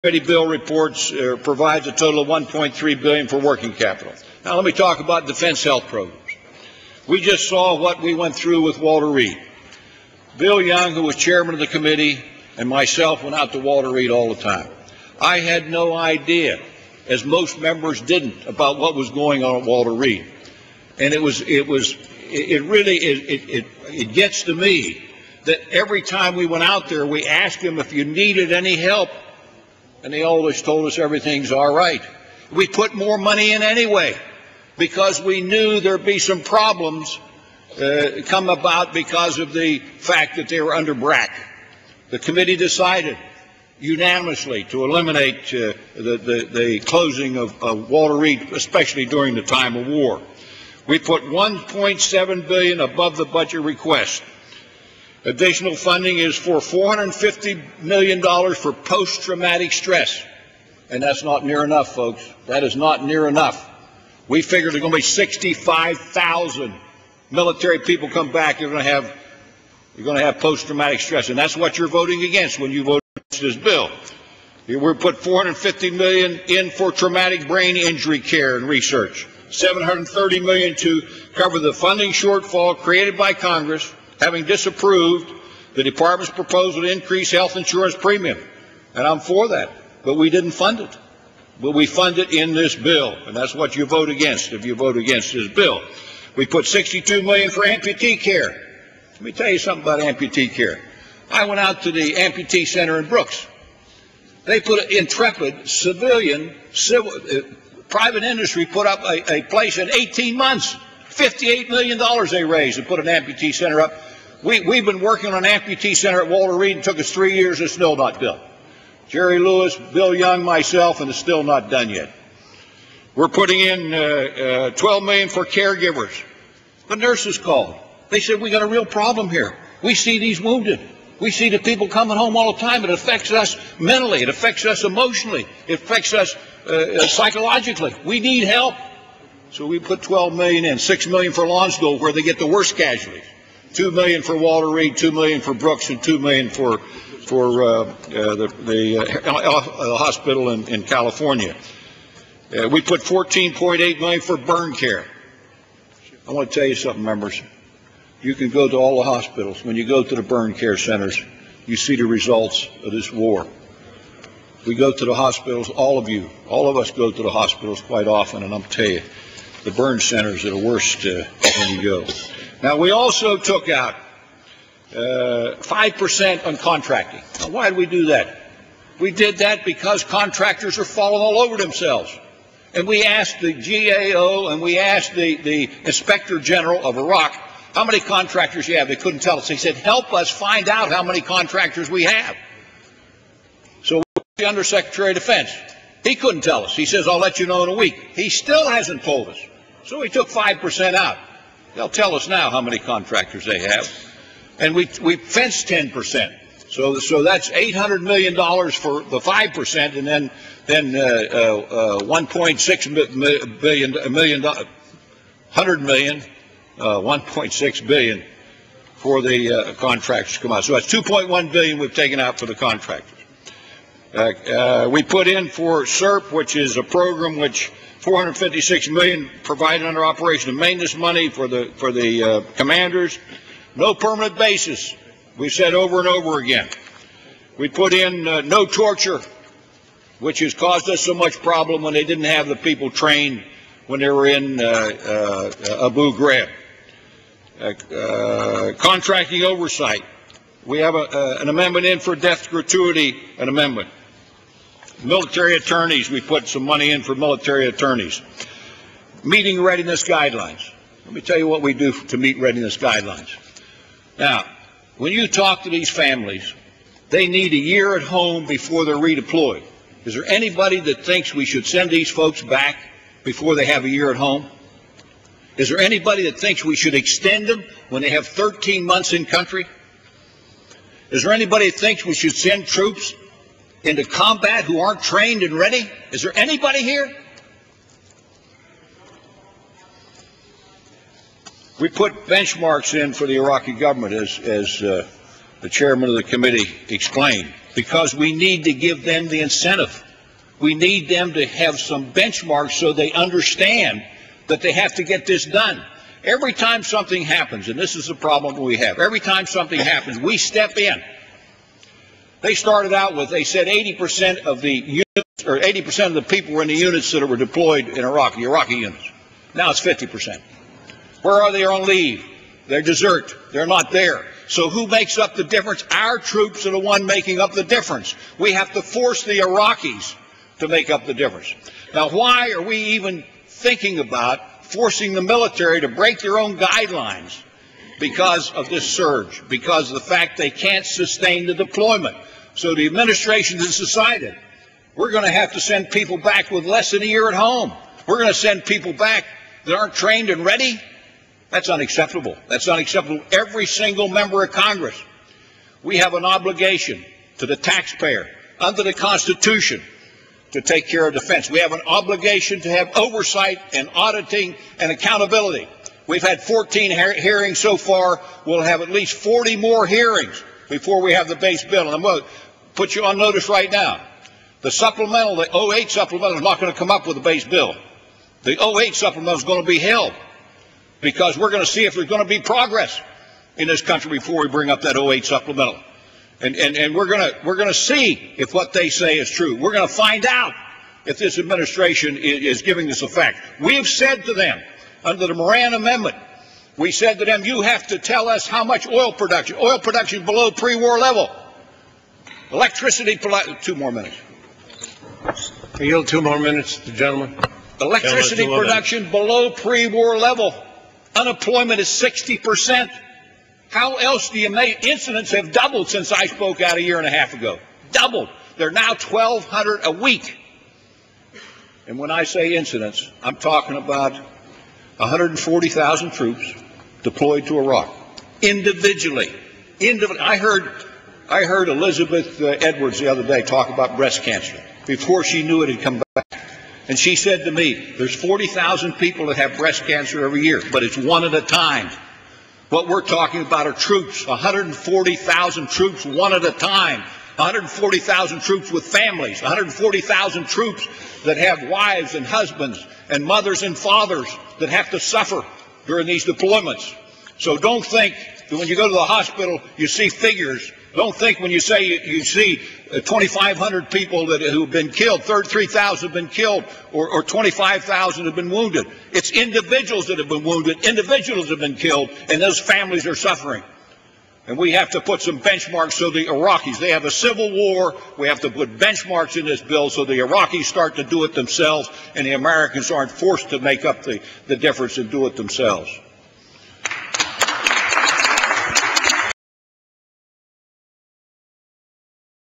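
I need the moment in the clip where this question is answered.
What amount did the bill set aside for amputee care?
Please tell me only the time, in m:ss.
1:36.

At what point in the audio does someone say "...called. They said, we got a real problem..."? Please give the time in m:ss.
2:07.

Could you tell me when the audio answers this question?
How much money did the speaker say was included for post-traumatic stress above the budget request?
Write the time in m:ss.
0:56.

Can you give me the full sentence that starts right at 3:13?
So we the Undersecretary of Defense.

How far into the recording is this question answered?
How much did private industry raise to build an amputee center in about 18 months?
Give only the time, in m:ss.
1:51.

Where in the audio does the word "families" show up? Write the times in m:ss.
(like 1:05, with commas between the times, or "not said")
4:25, 7:28, 7:52.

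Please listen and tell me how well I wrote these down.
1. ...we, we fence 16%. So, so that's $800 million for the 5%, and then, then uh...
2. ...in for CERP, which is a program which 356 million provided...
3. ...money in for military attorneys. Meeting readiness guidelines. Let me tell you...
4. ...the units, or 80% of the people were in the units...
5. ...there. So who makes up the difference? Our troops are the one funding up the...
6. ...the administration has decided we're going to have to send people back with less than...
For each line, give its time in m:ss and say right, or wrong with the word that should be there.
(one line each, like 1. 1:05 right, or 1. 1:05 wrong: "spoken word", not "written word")
1. 3:24 wrong: "10", not "16"
2. 3:45 wrong: "456", not "356"
3. 4:16 right
4. 5:14 right
5. 5:23 wrong: "making", not "funding"
6. 5:42 right.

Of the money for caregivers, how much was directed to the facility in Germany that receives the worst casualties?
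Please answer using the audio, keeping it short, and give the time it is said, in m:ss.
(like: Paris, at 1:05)
6 million, at 2:20.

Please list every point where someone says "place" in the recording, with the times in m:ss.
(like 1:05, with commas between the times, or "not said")
1:49.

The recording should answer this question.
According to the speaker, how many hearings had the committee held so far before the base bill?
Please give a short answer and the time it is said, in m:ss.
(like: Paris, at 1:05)
14, at 6:06.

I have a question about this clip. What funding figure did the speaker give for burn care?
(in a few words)
14.8 million.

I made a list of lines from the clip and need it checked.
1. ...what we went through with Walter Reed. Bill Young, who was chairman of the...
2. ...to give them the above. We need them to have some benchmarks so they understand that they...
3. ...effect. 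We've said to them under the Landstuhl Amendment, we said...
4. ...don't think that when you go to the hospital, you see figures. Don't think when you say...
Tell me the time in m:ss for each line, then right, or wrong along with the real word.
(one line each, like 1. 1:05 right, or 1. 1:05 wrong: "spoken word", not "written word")
1. 0:07 right
2. 4:58 wrong: "incentive", not "above"
3. 6:33 wrong: "Moran", not "Landstuhl"
4. 7:37 right.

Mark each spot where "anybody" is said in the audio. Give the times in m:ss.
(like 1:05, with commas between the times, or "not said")
4:30, 4:35, 4:41, 4:46.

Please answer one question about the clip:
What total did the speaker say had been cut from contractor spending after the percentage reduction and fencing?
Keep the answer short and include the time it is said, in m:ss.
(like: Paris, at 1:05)
$2.1 billion, at 3:40.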